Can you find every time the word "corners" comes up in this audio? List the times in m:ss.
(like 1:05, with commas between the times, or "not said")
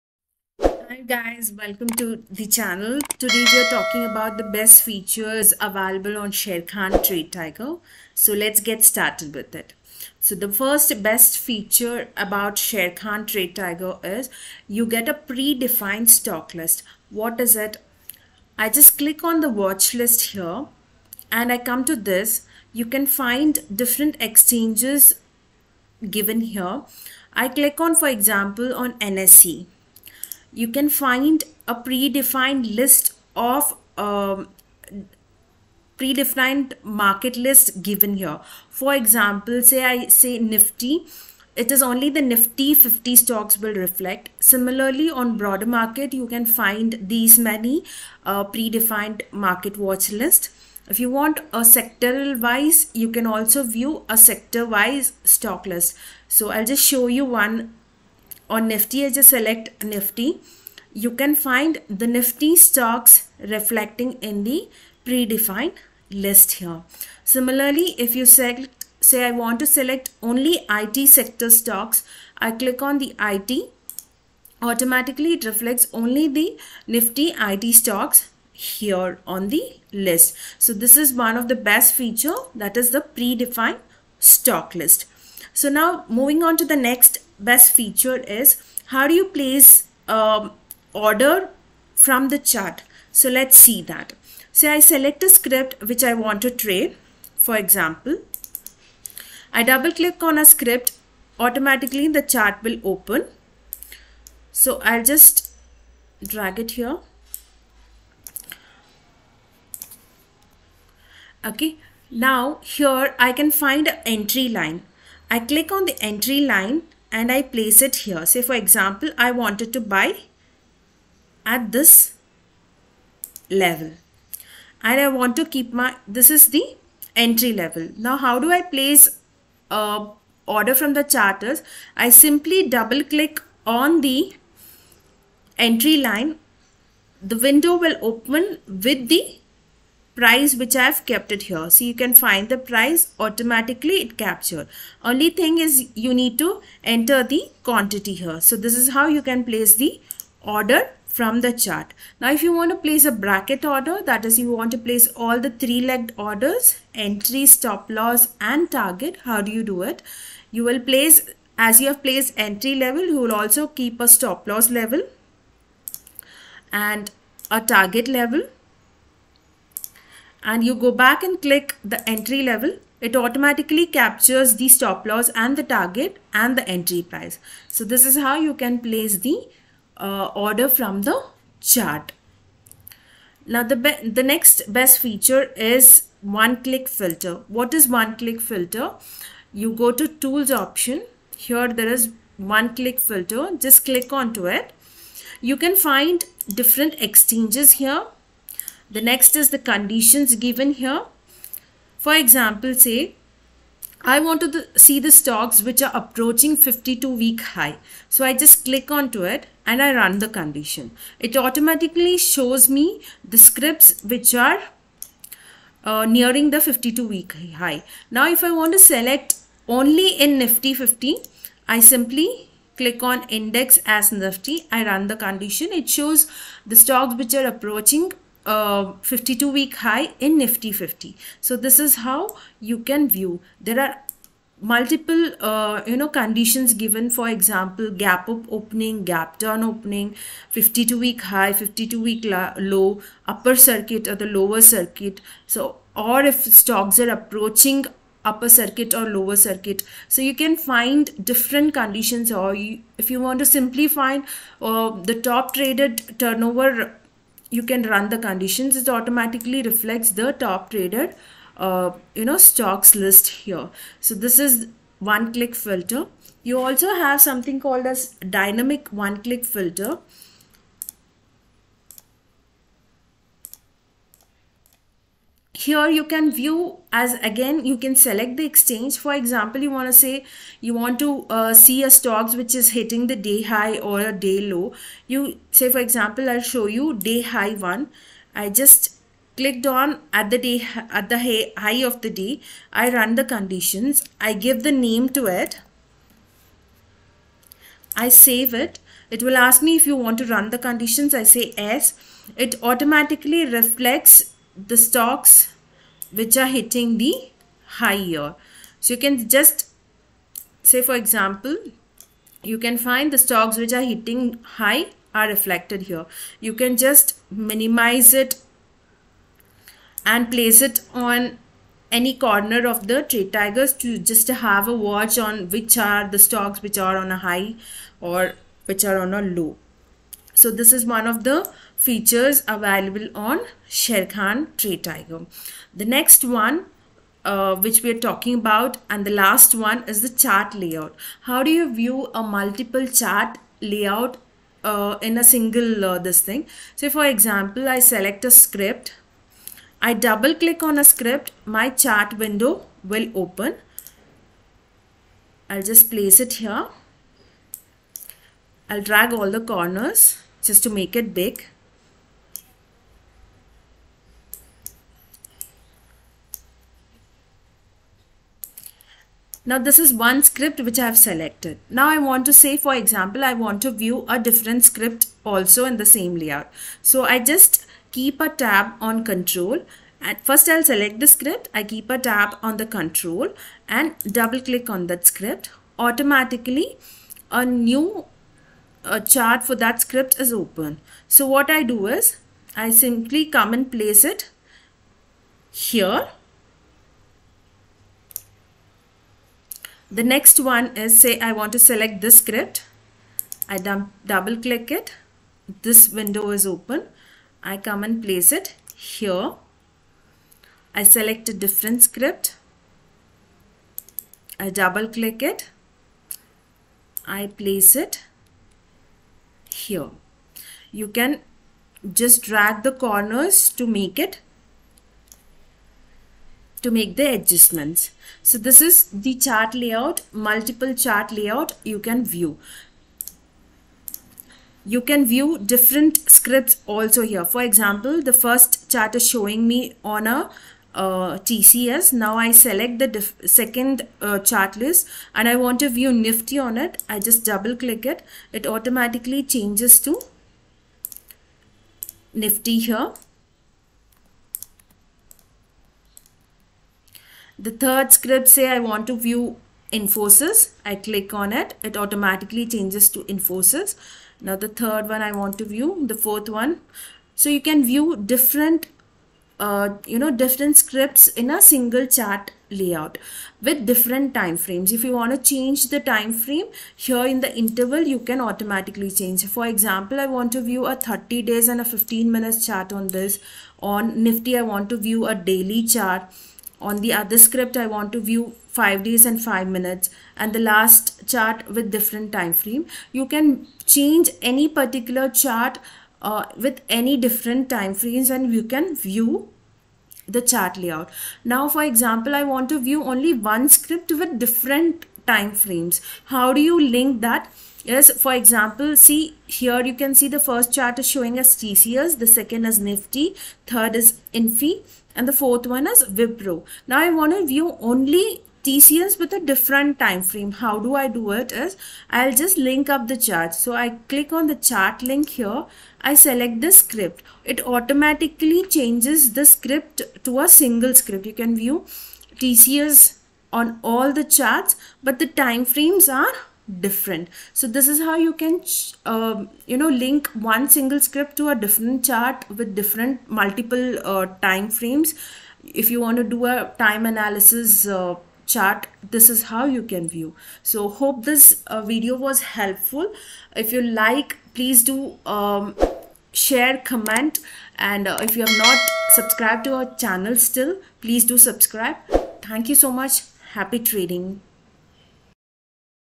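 5:22, 5:59, 7:02.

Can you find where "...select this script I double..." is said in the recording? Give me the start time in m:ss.
6:41.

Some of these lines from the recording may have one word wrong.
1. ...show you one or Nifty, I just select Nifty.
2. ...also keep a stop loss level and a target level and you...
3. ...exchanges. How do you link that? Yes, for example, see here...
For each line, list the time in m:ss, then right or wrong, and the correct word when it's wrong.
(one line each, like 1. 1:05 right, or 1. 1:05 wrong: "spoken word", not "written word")
1. 0:56 right
2. 2:43 right
3. 8:25 wrong: "frames", not "exchanges".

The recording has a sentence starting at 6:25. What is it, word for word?
Automatically a new chart for that script is open.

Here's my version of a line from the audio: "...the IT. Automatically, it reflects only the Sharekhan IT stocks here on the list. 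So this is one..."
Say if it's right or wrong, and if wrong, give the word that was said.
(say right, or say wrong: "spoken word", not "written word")
wrong: "Nifty", not "Sharekhan".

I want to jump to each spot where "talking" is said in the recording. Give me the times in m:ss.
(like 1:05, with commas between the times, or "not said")
0:03, 5:38.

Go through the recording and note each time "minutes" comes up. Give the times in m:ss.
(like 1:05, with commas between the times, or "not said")
8:02, 8:09.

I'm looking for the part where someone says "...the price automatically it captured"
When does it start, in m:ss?
2:22.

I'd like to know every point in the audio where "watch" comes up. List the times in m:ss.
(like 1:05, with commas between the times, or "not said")
0:19, 0:49, 5:24.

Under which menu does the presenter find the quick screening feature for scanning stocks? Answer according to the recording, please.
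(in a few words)
Tools.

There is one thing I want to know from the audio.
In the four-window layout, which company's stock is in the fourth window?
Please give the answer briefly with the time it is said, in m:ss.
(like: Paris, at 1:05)
Wipro, at 8:35.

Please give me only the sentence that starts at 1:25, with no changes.
So now moving on to the next best feature is how do you place um, order from the chart.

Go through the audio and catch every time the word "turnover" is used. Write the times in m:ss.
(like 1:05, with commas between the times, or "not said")
4:16.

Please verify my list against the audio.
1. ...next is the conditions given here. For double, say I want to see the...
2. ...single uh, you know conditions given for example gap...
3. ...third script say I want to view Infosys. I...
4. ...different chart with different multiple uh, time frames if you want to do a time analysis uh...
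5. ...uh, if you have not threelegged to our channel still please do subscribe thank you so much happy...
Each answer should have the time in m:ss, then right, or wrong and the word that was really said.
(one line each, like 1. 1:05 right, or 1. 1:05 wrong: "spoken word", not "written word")
1. 3:19 wrong: "example", not "double"
2. 3:54 wrong: "multiple", not "single"
3. 7:37 right
4. 9:01 right
5. 9:17 wrong: "subscribed", not "threelegged".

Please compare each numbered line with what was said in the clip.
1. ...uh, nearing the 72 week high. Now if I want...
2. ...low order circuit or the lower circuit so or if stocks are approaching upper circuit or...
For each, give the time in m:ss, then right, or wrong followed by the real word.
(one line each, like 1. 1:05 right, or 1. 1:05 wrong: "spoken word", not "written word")
1. 3:35 wrong: "52", not "72"
2. 4:02 wrong: "upper", not "order".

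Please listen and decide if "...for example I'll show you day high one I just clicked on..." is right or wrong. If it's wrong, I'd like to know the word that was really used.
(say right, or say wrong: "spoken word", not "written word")
right.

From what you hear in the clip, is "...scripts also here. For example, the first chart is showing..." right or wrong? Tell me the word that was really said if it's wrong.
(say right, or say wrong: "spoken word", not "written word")
right.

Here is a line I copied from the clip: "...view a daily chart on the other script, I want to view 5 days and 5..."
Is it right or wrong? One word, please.
right.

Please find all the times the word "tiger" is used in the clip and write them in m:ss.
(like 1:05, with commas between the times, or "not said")
0:07, 0:13, 5:23, 5:34.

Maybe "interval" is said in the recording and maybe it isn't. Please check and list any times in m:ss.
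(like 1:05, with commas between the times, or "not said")
7:57.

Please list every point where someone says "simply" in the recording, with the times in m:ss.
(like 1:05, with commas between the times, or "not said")
2:12, 3:41, 4:13, 6:32.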